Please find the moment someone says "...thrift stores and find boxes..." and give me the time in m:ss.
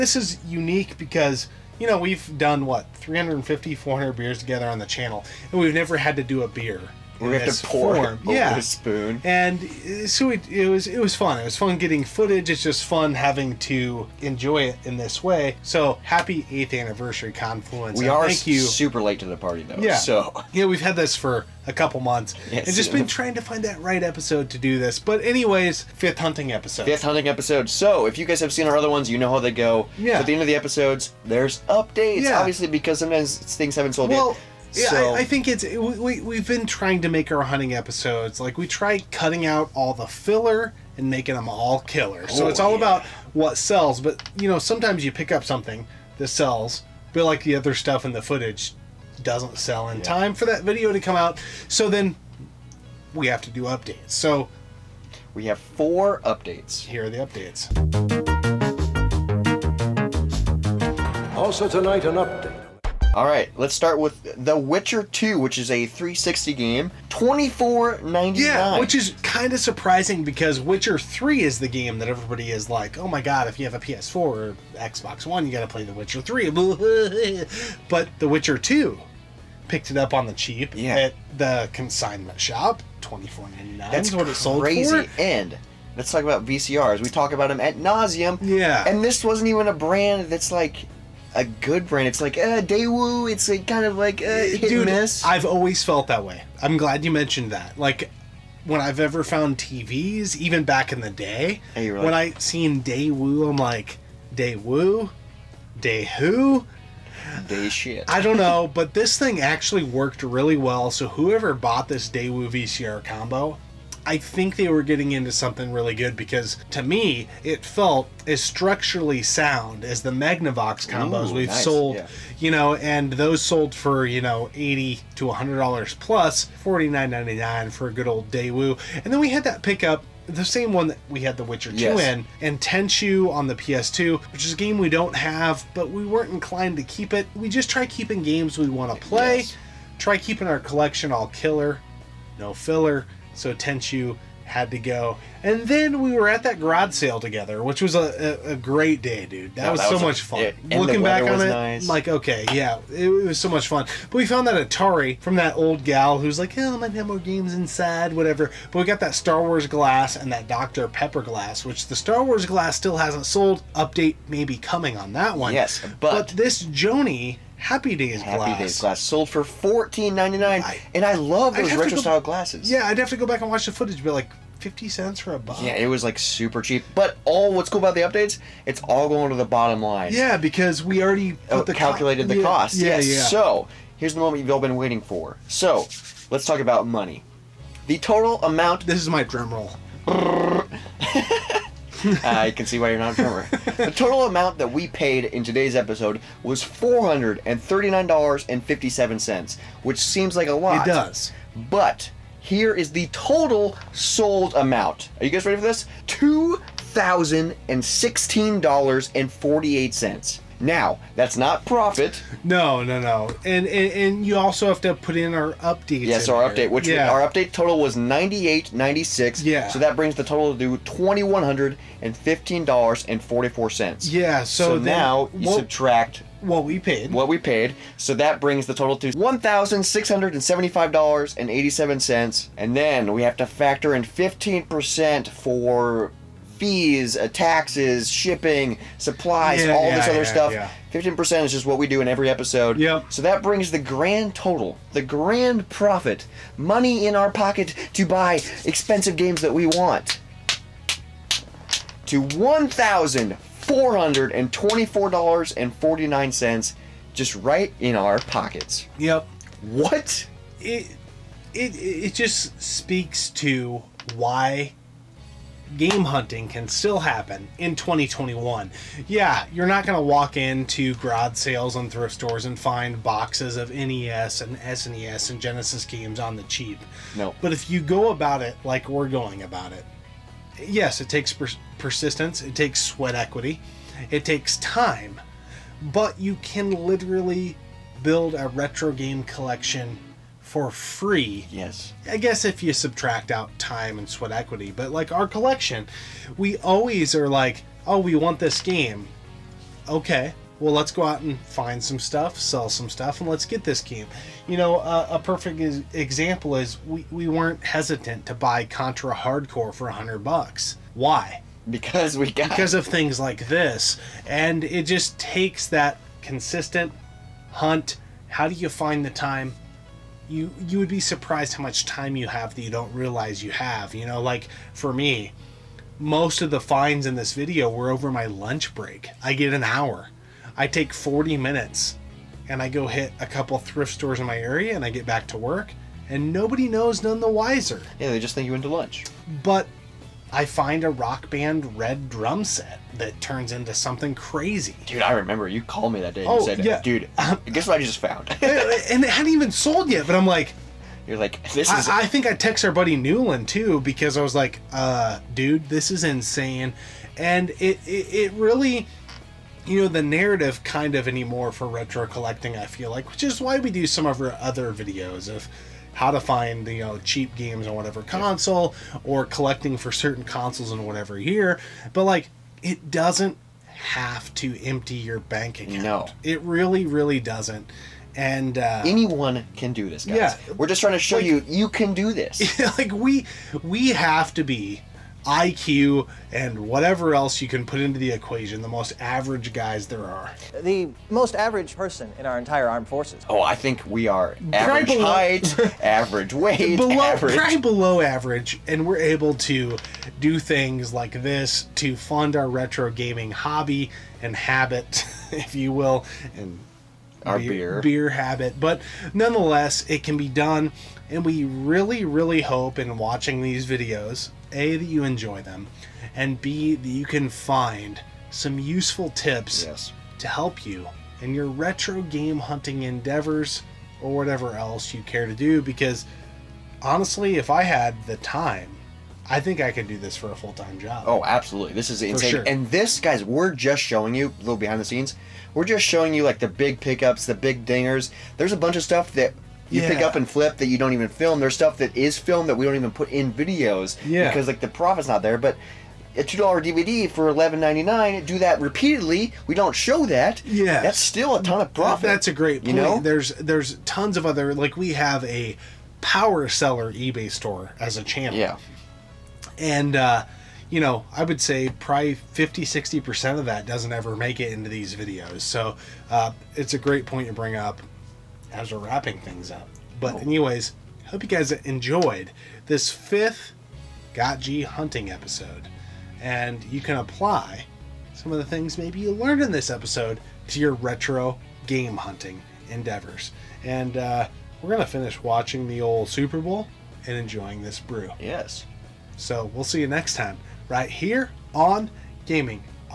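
4:31.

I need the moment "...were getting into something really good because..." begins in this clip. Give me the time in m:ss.
1:54.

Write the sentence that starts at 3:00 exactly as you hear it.
Yeah, because we already oh, the calculated co- the yeah, cost.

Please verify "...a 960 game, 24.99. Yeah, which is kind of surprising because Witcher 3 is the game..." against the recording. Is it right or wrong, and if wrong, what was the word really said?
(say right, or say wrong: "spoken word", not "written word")
wrong: "360", not "960".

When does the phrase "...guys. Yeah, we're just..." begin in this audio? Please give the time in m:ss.
6:20.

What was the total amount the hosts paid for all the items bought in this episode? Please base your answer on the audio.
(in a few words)
$439.57.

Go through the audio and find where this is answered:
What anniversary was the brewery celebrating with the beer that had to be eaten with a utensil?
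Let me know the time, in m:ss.
0:16.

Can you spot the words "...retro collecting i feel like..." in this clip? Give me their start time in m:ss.
6:01.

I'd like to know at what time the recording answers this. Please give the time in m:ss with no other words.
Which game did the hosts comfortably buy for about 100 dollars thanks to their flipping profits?
5:08.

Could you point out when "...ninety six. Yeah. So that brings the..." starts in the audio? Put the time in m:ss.
3:38.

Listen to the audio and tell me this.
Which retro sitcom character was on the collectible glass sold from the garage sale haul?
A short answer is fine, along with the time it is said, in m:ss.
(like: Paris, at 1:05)
Joanie, at 2:46.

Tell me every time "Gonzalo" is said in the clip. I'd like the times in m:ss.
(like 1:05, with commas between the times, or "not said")
not said.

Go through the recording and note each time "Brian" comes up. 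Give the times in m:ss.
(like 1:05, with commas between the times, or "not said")
not said.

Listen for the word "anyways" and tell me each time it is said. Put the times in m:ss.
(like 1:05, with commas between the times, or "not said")
0:25, 7:50.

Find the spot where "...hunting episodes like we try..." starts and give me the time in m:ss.
0:37.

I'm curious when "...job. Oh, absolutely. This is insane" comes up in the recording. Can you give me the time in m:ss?
7:10.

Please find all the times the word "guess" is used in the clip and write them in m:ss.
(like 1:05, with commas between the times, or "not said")
4:52, 5:47.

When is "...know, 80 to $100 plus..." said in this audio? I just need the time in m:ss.
2:04.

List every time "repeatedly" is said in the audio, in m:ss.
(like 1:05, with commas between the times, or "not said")
7:28.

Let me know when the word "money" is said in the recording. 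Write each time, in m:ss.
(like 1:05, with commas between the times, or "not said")
3:06, 4:06.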